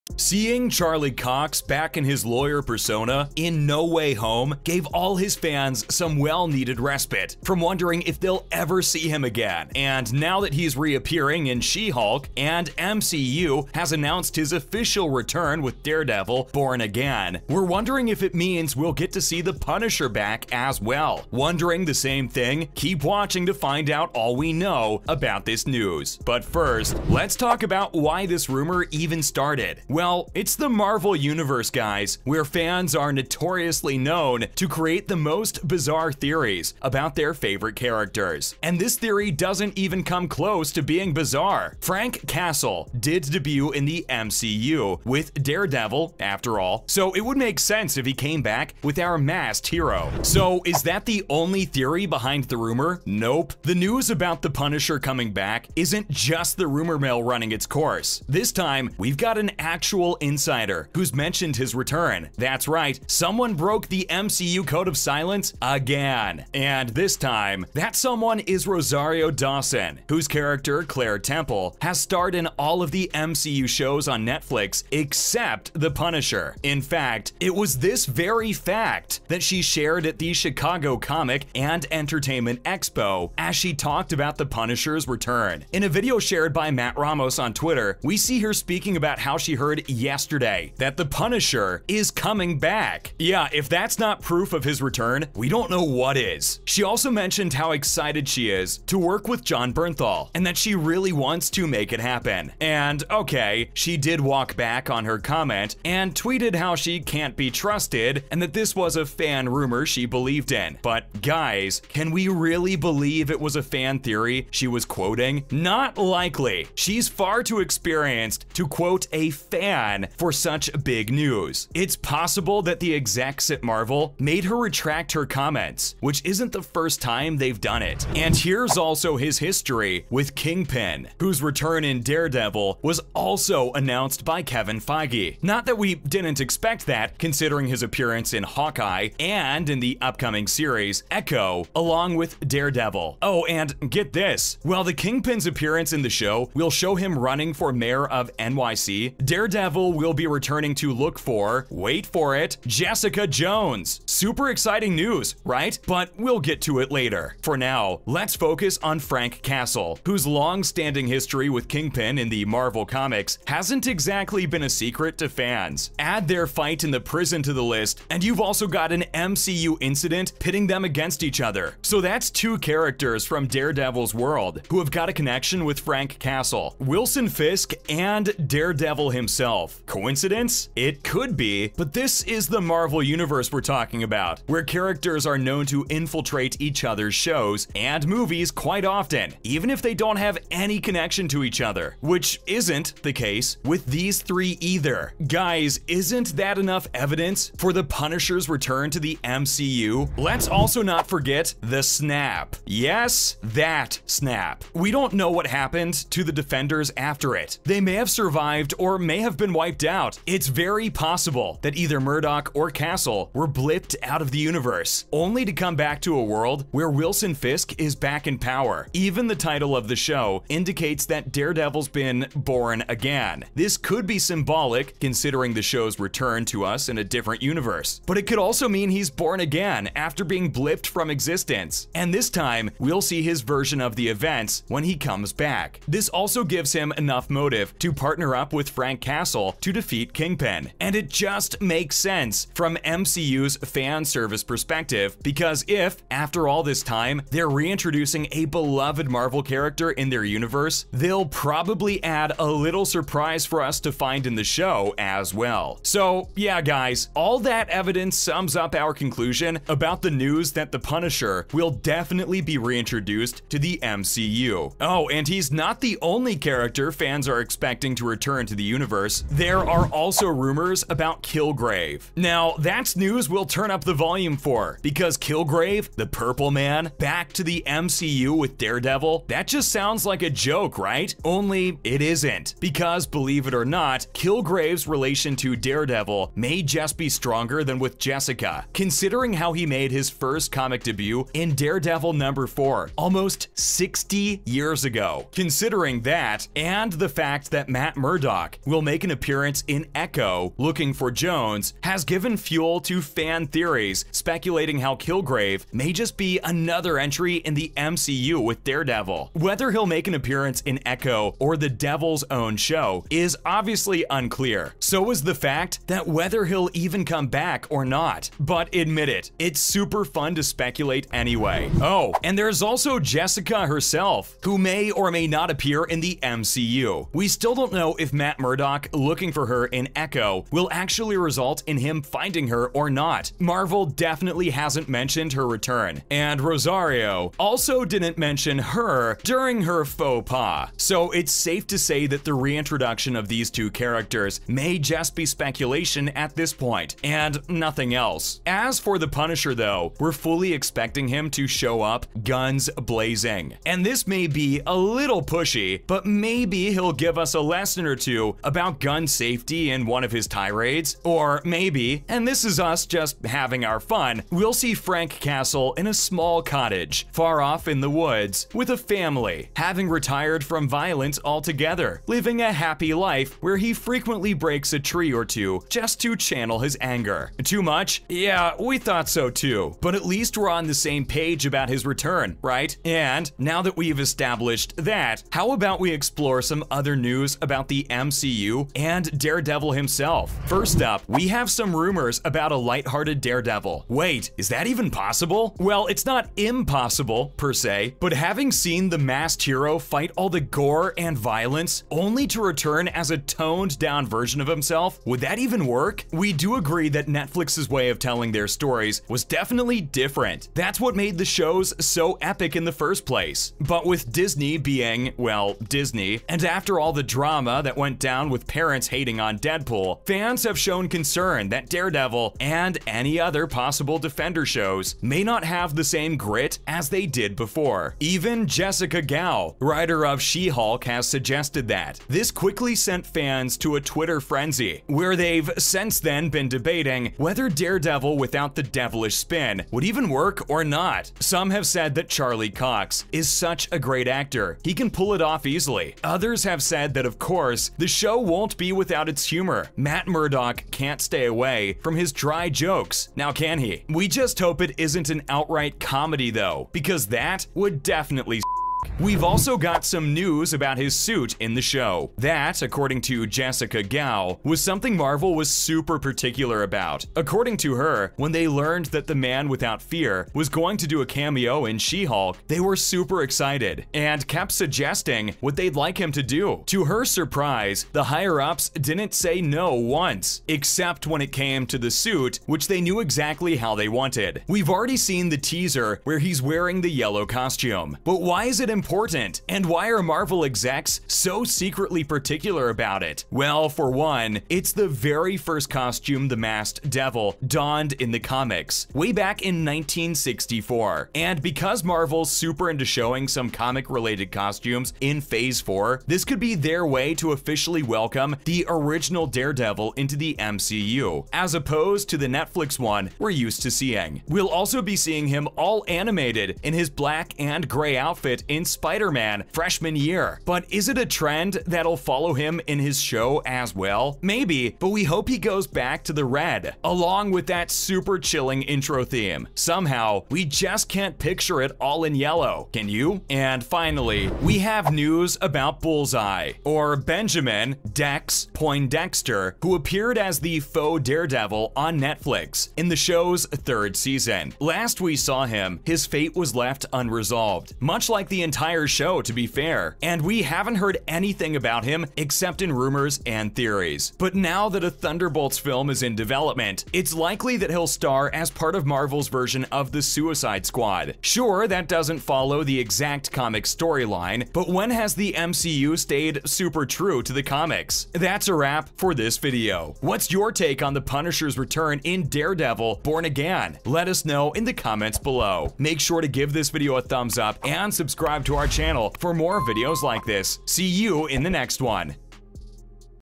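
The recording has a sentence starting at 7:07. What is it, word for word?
Even Jessica Gao, writer of She-Hulk, has suggested that.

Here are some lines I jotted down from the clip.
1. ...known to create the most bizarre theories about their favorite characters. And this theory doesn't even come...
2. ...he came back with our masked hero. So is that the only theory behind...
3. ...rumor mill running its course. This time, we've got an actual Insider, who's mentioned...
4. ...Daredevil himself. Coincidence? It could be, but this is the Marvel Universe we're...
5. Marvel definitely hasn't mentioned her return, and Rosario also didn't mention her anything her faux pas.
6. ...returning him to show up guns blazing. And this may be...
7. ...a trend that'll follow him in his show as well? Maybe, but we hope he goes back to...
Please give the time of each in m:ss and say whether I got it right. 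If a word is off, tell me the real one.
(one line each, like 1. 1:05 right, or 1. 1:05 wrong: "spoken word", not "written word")
1. 0:33 right
2. 0:48 right
3. 0:56 right
4. 2:58 right
5. 5:33 wrong: "during", not "anything"
6. 5:50 wrong: "expecting", not "returning"
7. 8:40 right.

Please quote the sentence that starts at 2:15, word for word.
Not that we didn't expect that, considering his appearance in Hawkeye and in the upcoming series Echo, along with Daredevil.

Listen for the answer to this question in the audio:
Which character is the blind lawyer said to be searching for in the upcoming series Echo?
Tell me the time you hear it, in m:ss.
2:32.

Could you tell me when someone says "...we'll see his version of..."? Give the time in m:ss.
3:52.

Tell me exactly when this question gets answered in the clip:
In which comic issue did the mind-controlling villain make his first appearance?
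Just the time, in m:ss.
4:51.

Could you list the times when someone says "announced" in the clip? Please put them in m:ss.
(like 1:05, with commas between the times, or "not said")
0:13, 2:13.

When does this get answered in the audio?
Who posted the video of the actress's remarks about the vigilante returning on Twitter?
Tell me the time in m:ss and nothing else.
1:26.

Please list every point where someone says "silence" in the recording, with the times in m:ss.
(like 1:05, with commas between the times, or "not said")
1:04.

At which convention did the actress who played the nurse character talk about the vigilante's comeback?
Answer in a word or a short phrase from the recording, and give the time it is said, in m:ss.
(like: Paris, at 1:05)
Chicago Comic and Entertainment Expo, at 1:20.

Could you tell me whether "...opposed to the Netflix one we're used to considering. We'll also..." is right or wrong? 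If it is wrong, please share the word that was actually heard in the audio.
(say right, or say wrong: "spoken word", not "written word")
wrong: "seeing", not "considering".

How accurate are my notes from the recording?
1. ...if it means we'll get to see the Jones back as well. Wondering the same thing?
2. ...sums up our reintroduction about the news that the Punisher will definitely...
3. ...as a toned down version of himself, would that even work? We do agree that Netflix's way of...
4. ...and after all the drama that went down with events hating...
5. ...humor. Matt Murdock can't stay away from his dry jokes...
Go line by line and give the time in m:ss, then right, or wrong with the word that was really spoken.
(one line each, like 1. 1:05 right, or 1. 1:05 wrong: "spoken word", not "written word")
1. 0:18 wrong: "Punisher", not "Jones"
2. 4:18 wrong: "conclusion", not "reintroduction"
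3. 6:42 right
4. 6:56 wrong: "parents", not "events"
5. 7:29 right.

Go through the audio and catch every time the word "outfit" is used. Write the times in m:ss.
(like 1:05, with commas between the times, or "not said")
8:37.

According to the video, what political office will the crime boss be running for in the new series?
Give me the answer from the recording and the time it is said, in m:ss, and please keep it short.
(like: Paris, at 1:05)
mayor of NYC, at 2:27.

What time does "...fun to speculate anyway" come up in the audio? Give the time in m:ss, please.
5:20.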